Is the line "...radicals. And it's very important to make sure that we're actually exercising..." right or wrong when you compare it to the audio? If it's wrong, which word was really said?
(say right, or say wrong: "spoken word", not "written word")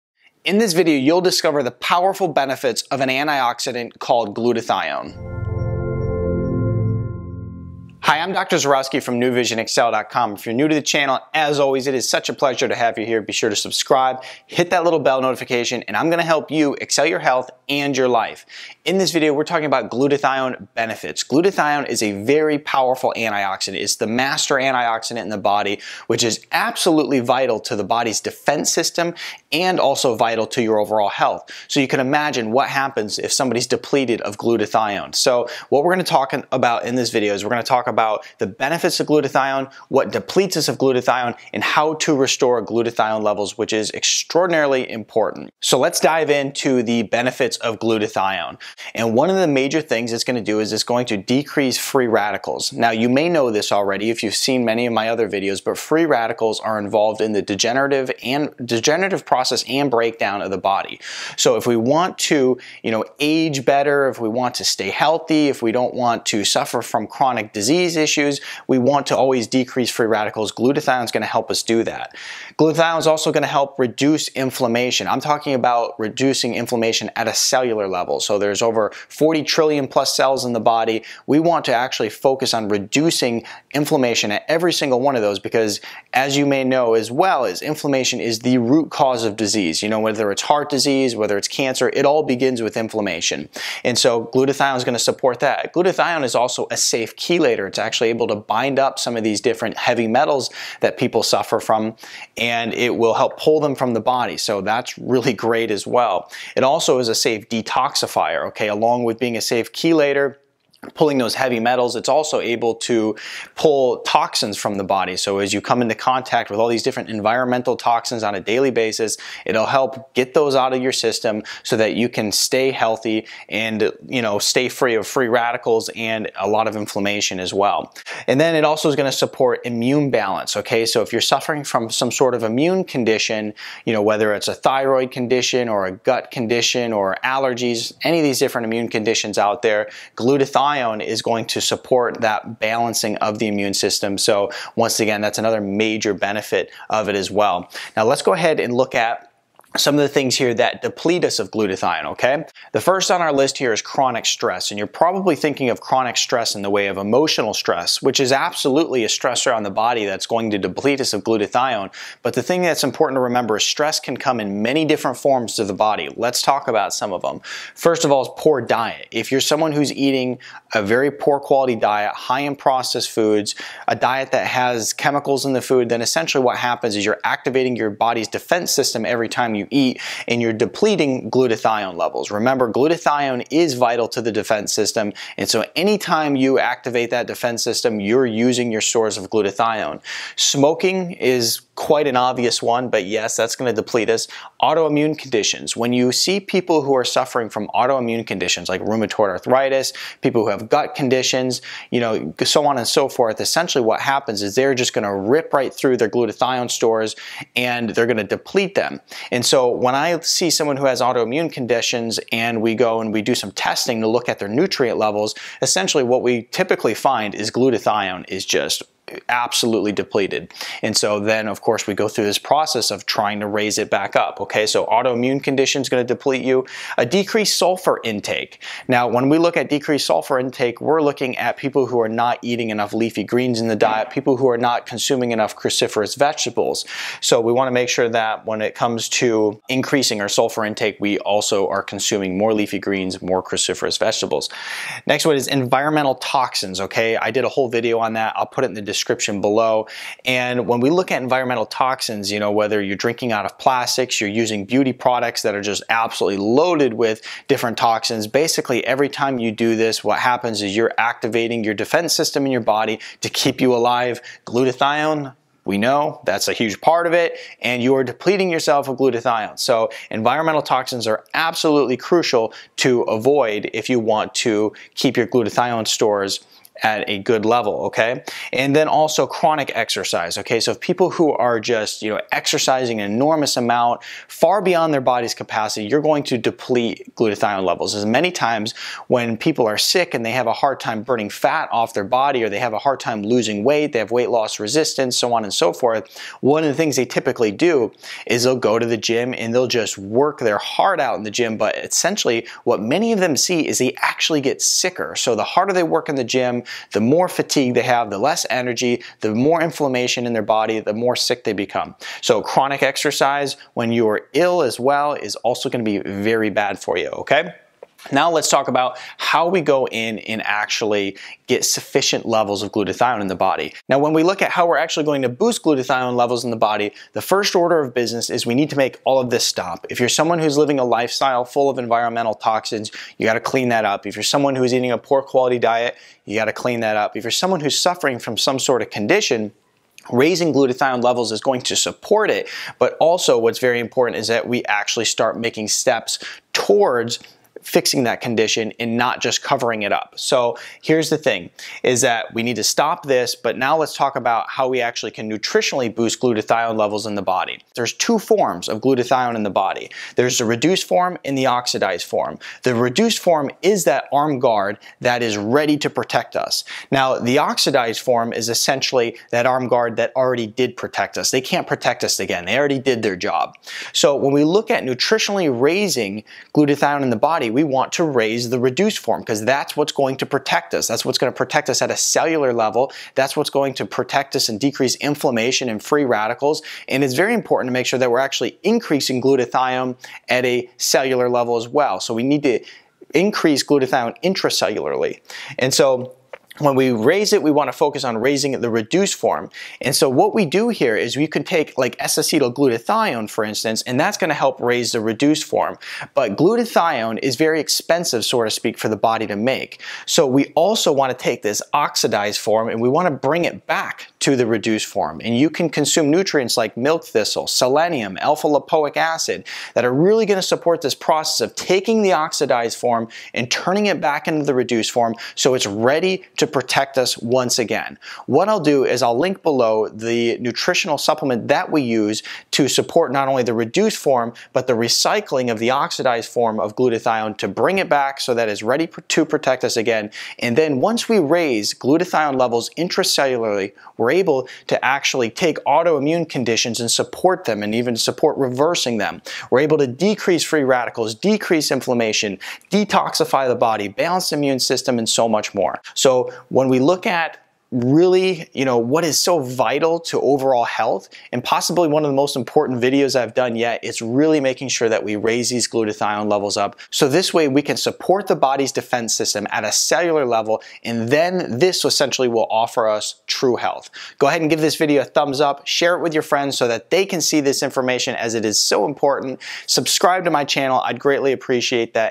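wrong: "increasing", not "exercising".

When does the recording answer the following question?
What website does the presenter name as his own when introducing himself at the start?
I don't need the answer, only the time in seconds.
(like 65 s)
9 s.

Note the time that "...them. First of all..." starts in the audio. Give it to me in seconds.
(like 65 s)
167 s.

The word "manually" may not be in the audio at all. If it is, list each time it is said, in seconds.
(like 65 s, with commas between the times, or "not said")
not said.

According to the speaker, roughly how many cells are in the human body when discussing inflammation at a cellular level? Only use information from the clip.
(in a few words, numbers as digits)
40 trillion.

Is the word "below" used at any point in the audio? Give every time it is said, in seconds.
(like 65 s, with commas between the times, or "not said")
249 s, 429 s.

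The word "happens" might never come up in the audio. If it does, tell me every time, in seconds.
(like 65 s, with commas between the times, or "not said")
32 s, 176 s, 204 s, 260 s.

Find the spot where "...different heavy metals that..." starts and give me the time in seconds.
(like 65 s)
99 s.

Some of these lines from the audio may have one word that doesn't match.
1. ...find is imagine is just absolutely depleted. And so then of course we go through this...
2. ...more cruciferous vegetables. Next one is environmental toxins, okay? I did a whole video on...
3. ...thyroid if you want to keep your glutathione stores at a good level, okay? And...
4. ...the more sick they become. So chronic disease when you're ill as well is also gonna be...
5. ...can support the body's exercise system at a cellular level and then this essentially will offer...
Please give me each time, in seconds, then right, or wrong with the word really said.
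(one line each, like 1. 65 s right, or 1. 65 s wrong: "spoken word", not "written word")
1. 216 s wrong: "glutathione", not "imagine"
2. 243 s right
3. 273 s wrong: "avoid", not "thyroid"
4. 310 s wrong: "exercise", not "disease"
5. 467 s wrong: "defense", not "exercise".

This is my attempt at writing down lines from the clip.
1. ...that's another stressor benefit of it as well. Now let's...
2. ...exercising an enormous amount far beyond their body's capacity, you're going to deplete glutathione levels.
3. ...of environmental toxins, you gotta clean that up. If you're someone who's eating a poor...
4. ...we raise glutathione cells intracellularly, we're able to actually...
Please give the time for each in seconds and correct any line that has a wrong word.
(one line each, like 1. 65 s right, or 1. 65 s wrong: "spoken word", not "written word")
1. 145 s wrong: "major", not "stressor"
2. 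282 s right
3. 331 s right
4. 441 s wrong: "levels", not "cells".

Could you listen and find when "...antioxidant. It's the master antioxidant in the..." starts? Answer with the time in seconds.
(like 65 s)
23 s.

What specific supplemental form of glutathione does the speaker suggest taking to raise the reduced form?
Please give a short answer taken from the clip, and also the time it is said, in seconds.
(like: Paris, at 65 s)
S-acetylglutathione, at 401 s.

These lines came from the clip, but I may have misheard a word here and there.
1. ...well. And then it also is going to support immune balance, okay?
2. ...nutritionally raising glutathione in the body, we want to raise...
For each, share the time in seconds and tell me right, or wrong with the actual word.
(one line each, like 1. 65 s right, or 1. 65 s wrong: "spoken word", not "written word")
1. 127 s right
2. 374 s right.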